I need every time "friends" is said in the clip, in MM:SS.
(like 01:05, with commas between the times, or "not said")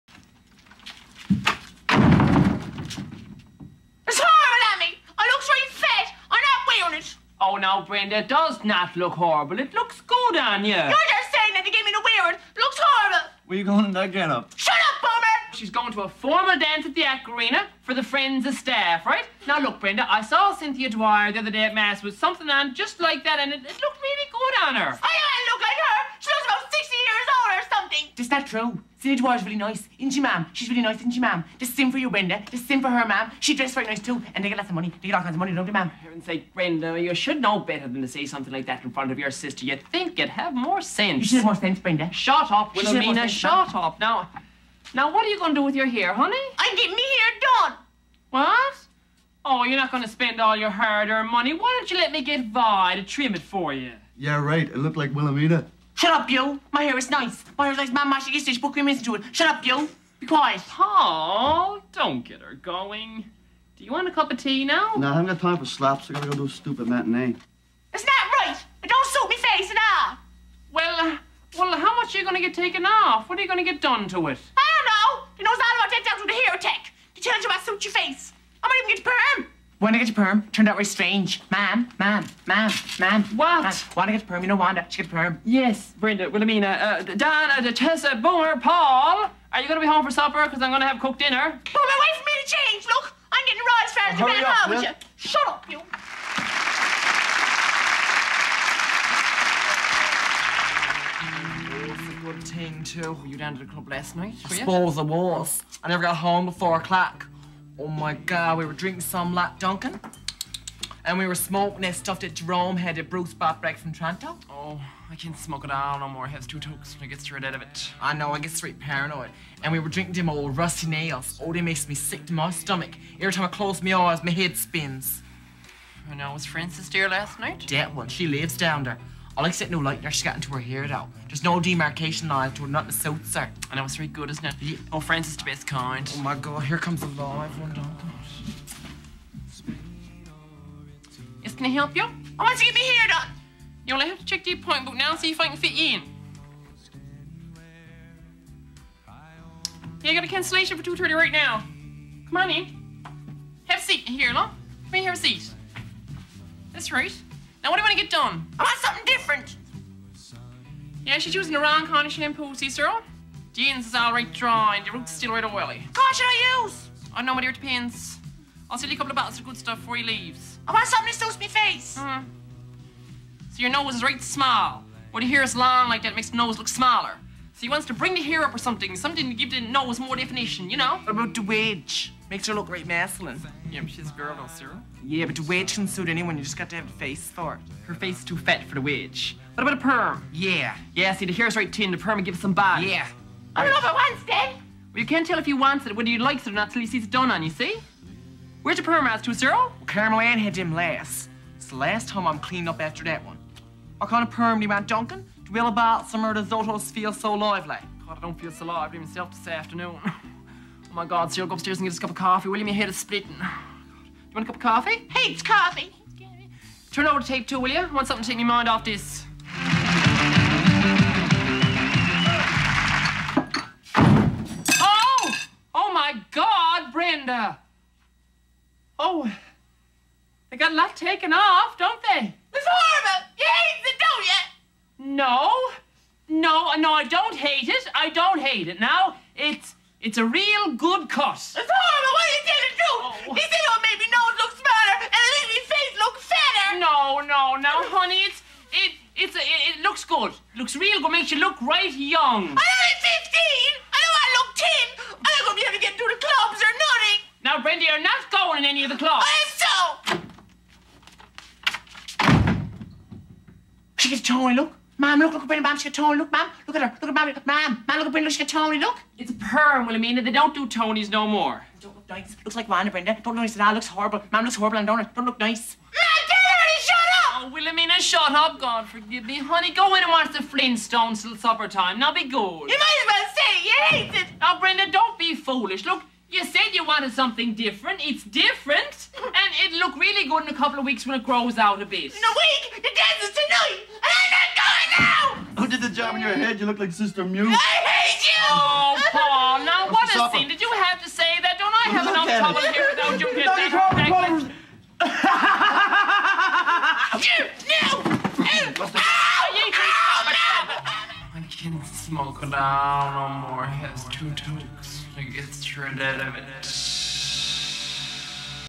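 00:18, 02:14.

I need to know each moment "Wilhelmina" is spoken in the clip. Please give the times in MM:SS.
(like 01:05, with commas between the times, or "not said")
00:42, 00:55, 01:26, 04:29, 04:37.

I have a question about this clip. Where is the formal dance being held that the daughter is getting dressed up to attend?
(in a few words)
the Aquarena.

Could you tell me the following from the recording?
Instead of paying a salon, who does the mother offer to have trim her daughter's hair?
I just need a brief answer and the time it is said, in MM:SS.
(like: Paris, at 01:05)
Vi, at 00:52.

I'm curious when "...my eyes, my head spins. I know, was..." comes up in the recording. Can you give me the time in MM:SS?
02:03.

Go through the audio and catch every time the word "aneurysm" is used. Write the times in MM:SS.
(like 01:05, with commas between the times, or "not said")
not said.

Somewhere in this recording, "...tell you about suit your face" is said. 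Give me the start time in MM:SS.
01:17.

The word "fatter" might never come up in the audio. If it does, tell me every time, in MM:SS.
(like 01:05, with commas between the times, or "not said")
04:06.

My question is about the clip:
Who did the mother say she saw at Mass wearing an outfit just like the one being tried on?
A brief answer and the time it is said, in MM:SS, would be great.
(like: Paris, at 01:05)
Cynthia Dwyer, at 00:20.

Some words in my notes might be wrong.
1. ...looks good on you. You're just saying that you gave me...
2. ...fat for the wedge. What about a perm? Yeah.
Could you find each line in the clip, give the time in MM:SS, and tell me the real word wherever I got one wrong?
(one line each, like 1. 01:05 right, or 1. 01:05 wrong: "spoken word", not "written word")
1. 00:09 right
2. 03:08 right.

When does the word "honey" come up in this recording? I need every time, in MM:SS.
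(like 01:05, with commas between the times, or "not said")
00:46, 04:07, 04:39.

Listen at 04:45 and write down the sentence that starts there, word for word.
Look, you said you wanted something different.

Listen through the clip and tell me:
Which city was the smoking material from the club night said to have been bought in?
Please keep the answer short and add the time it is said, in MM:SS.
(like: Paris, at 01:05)
Toronto, at 01:53.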